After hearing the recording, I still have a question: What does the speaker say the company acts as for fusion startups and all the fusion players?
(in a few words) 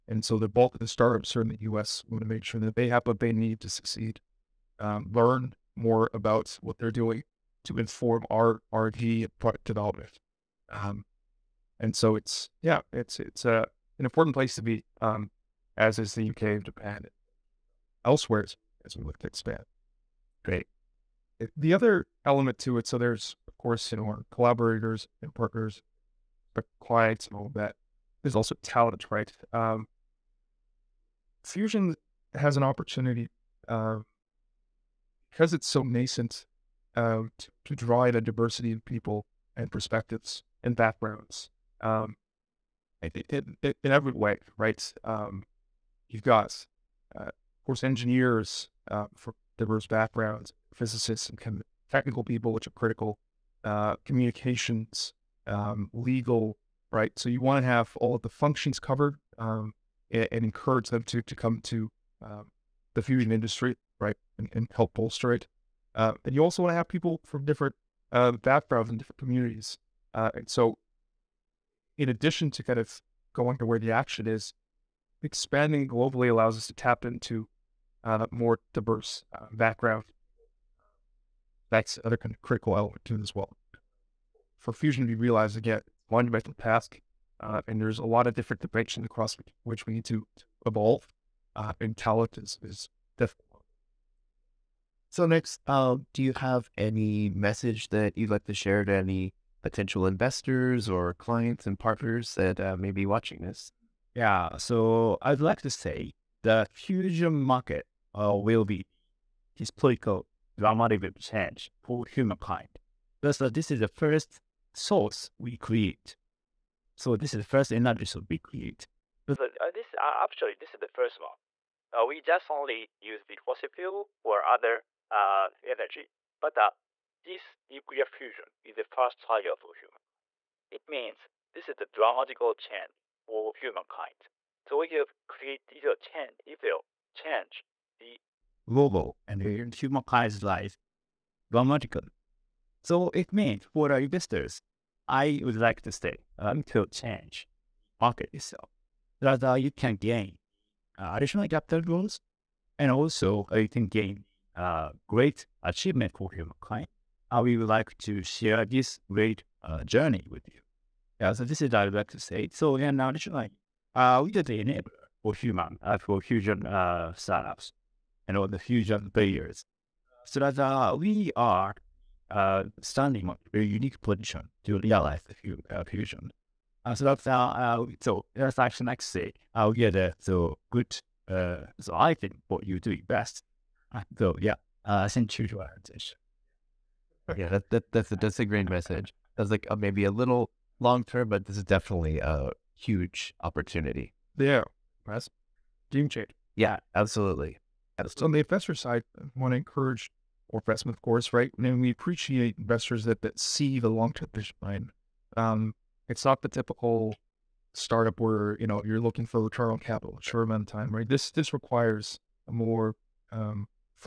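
Enabler.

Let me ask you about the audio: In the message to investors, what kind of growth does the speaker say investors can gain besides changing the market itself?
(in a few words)
Capital growth.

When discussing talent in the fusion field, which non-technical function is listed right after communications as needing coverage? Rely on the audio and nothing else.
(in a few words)
Legal.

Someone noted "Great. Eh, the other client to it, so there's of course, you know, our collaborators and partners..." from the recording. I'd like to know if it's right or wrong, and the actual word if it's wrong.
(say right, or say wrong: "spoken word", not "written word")
wrong: "element", not "client".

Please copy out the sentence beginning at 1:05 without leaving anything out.
Uh, and you also want to have people from different uh, backgrounds and different communities.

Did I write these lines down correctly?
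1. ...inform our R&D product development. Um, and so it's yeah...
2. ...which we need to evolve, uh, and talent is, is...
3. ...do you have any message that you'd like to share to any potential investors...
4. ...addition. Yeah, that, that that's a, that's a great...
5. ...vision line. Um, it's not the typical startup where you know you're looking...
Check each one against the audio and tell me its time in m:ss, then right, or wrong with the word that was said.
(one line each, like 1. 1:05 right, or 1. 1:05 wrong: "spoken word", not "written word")
1. 0:07 right
2. 1:29 right
3. 1:36 right
4. 3:05 wrong: "attention", not "addition"
5. 3:24 right.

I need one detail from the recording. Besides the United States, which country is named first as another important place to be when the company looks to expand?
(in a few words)
UK.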